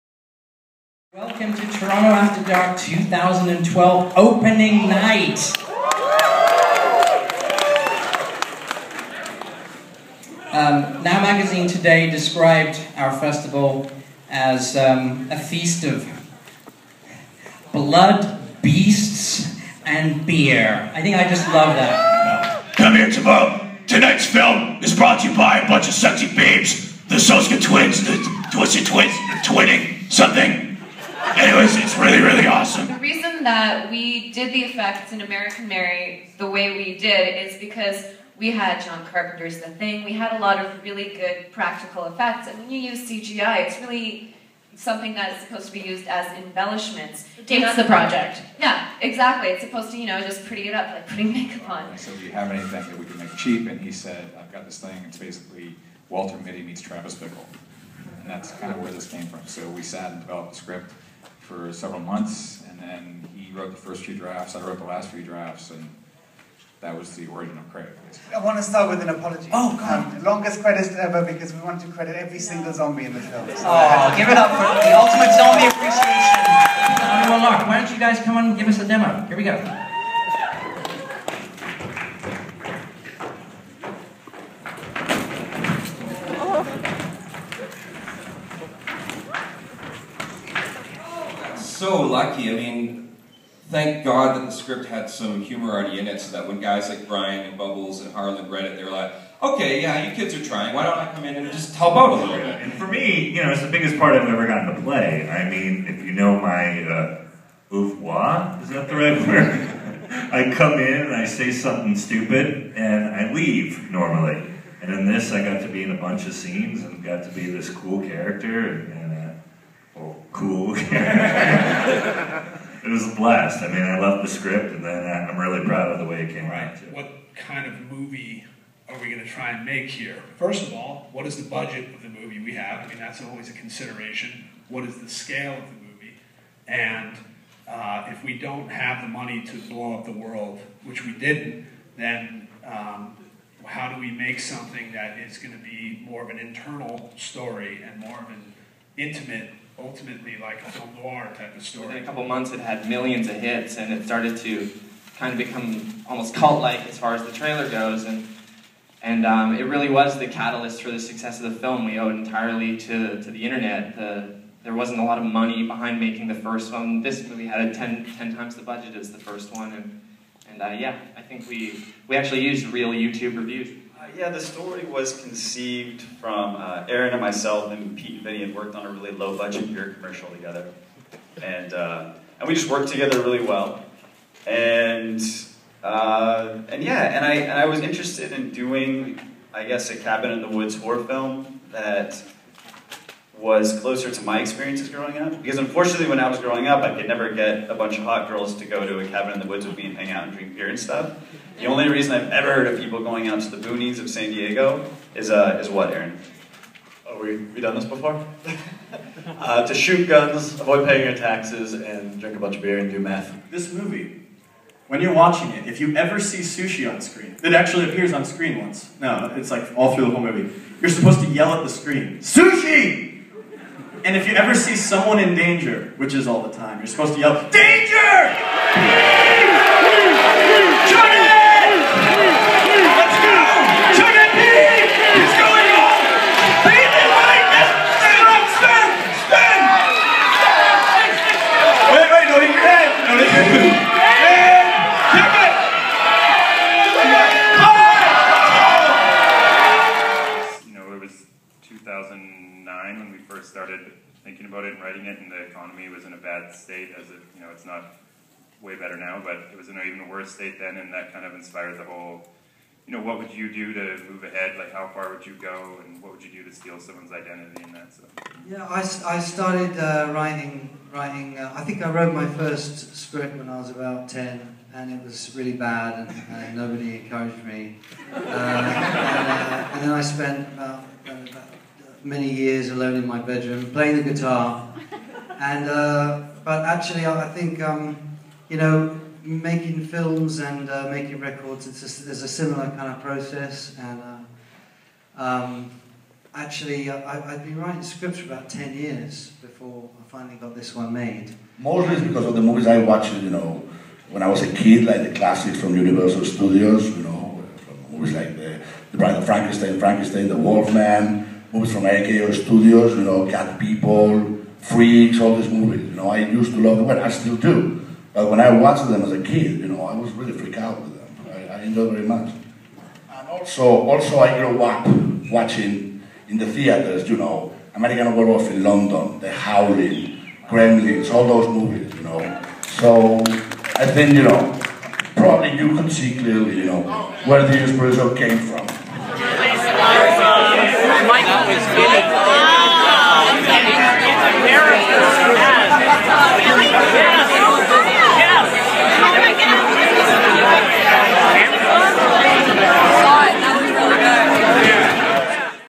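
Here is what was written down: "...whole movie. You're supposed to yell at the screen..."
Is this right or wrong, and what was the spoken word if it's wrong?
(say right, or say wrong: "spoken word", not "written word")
right.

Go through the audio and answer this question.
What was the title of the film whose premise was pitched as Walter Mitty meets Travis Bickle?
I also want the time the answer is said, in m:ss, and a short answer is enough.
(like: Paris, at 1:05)
Crave, at 1:07.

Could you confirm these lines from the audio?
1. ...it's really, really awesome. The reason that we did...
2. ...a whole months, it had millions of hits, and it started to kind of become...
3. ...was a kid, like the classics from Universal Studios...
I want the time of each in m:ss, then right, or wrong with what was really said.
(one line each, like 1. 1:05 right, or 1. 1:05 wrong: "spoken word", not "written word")
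1. 0:31 right
2. 2:32 wrong: "couple", not "whole"
3. 5:04 right.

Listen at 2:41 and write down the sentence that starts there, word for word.
We owed entirely to to the internet.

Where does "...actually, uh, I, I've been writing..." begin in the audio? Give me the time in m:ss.
4:56.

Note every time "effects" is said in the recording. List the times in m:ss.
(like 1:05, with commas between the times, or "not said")
0:34, 0:42.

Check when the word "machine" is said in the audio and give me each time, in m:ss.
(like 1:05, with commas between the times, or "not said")
not said.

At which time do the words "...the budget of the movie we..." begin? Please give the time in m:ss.
2:11.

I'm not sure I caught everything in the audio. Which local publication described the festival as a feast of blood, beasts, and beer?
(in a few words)
Now Magazine.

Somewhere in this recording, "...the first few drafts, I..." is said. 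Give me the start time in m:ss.
1:03.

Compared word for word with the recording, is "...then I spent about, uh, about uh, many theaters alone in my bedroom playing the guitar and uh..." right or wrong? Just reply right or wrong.
wrong.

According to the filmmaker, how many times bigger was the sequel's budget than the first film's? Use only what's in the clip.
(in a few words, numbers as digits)
10.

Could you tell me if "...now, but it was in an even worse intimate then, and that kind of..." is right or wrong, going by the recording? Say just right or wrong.
wrong.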